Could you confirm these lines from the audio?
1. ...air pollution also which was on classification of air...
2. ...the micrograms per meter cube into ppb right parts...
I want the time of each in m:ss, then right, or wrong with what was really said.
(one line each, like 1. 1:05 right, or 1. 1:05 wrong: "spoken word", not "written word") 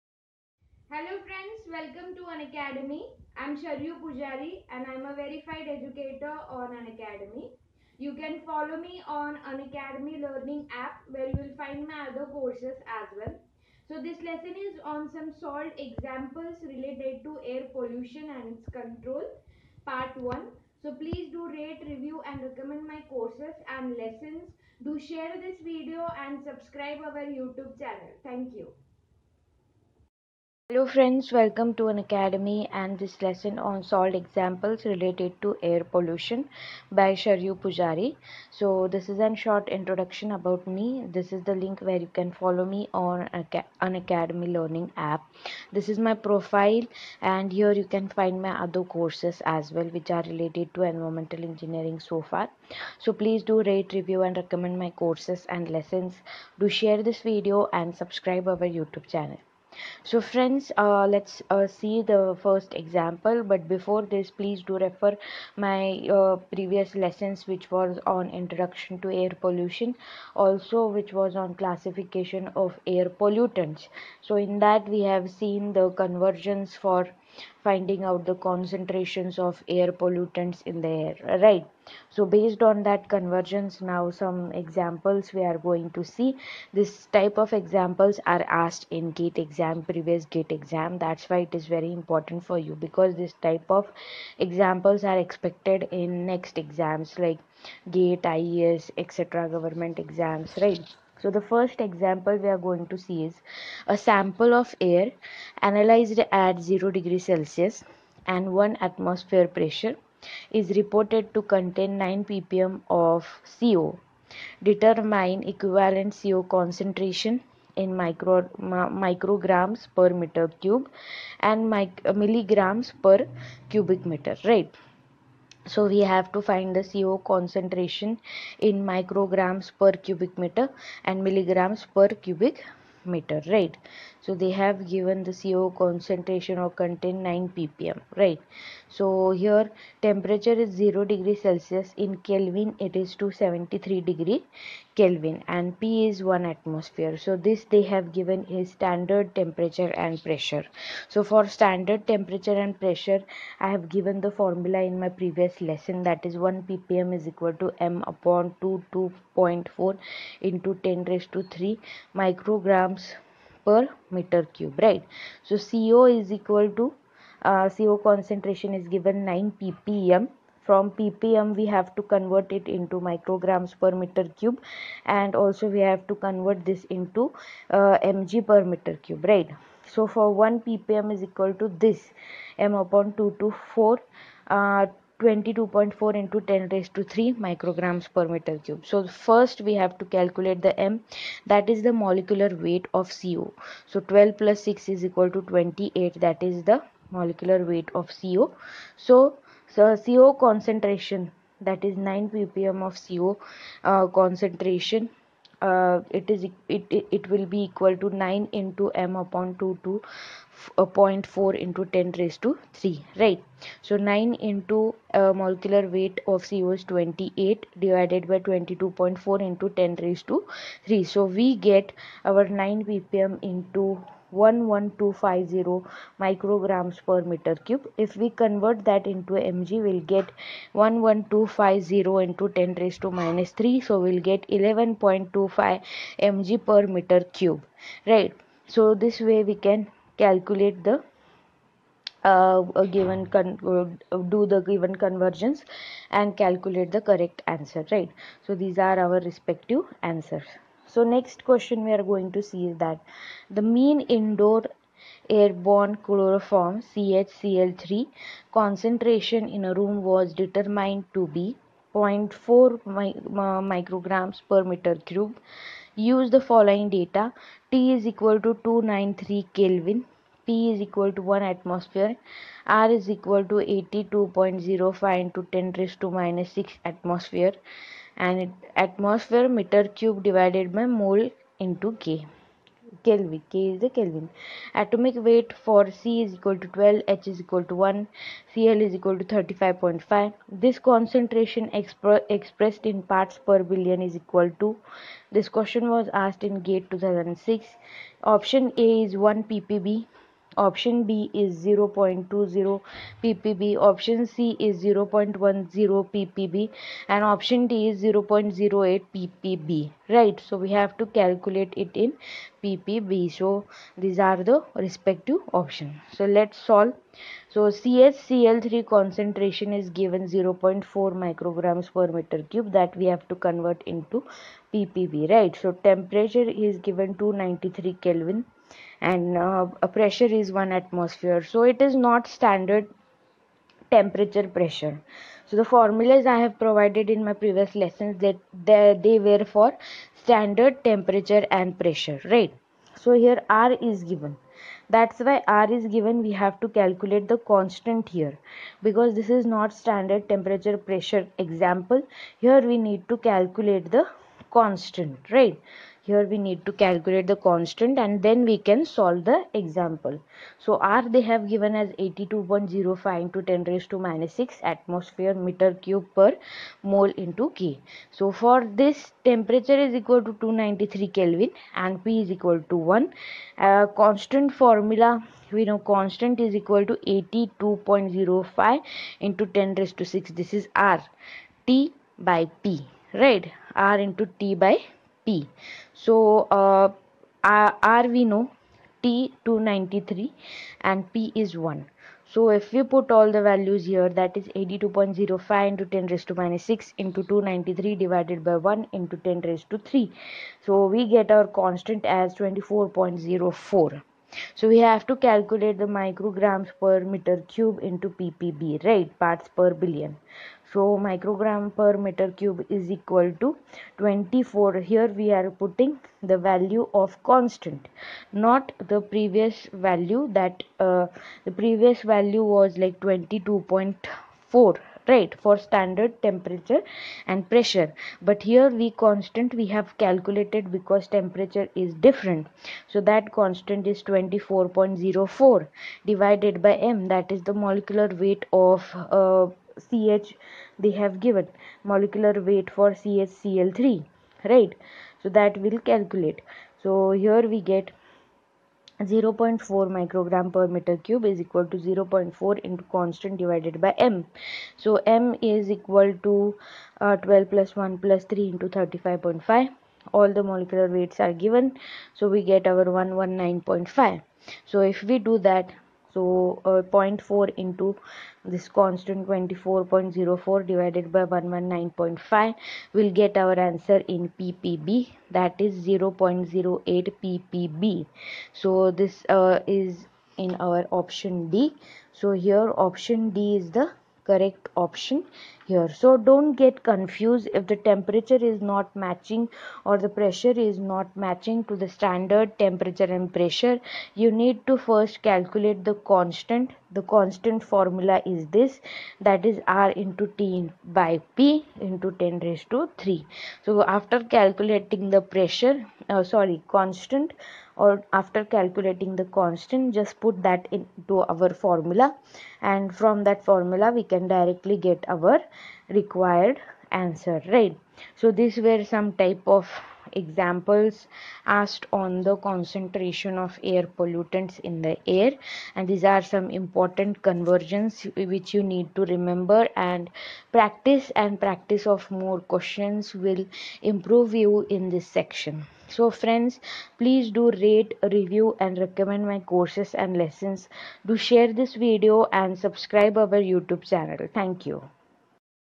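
1. 1:09 right
2. 6:45 right.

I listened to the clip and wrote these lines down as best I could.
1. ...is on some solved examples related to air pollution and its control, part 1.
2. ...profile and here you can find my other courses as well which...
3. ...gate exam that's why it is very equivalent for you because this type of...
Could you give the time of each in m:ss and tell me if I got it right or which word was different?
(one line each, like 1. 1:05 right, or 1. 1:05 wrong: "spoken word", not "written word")
1. 0:14 right
2. 0:46 right
3. 1:30 wrong: "important", not "equivalent".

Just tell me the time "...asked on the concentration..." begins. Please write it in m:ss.
8:41.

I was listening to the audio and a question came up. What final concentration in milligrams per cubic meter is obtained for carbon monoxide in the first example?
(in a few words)
11.25.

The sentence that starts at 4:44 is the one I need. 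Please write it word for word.
Atomic weight for C is equal to 12, H is equal to 1, Cl is equal to 35.5.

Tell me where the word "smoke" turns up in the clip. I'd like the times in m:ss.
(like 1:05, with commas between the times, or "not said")
not said.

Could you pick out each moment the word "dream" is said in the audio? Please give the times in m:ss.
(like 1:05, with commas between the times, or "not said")
not said.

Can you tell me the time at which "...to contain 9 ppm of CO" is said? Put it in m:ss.
1:51.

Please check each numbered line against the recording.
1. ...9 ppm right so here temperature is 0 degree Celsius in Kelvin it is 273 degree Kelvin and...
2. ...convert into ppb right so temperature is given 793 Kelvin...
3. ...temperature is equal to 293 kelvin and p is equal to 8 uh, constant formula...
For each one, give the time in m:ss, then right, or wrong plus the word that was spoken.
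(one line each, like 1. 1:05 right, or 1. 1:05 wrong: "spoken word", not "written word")
1. 2:17 right
2. 5:23 wrong: "293", not "793"
3. 6:09 wrong: "1", not "8".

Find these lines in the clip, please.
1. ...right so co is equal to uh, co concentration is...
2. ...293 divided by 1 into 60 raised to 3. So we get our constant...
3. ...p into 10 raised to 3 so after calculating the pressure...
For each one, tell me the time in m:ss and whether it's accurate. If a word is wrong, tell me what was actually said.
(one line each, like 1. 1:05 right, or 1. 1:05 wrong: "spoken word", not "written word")
1. 2:44 right
2. 6:37 wrong: "10", not "60"
3. 8:21 right.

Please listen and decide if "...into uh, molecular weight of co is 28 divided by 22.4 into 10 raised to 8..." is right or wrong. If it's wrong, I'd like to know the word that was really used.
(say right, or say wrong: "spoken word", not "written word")
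wrong: "3", not "8".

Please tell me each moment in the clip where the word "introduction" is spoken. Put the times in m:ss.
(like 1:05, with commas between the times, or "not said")
0:39, 1:08.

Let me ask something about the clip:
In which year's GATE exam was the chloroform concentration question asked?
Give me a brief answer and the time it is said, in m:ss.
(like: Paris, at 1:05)
2006, at 4:56.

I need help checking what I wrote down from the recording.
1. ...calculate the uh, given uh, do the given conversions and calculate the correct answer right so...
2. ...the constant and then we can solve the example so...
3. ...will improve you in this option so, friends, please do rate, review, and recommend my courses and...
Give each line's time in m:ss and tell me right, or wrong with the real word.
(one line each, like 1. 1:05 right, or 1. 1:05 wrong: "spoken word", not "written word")
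1. 4:00 right
2. 5:57 right
3. 8:53 wrong: "section", not "option".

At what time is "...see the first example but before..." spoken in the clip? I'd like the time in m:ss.
1:01.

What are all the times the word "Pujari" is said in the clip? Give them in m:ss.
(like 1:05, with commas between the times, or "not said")
0:04, 0:37.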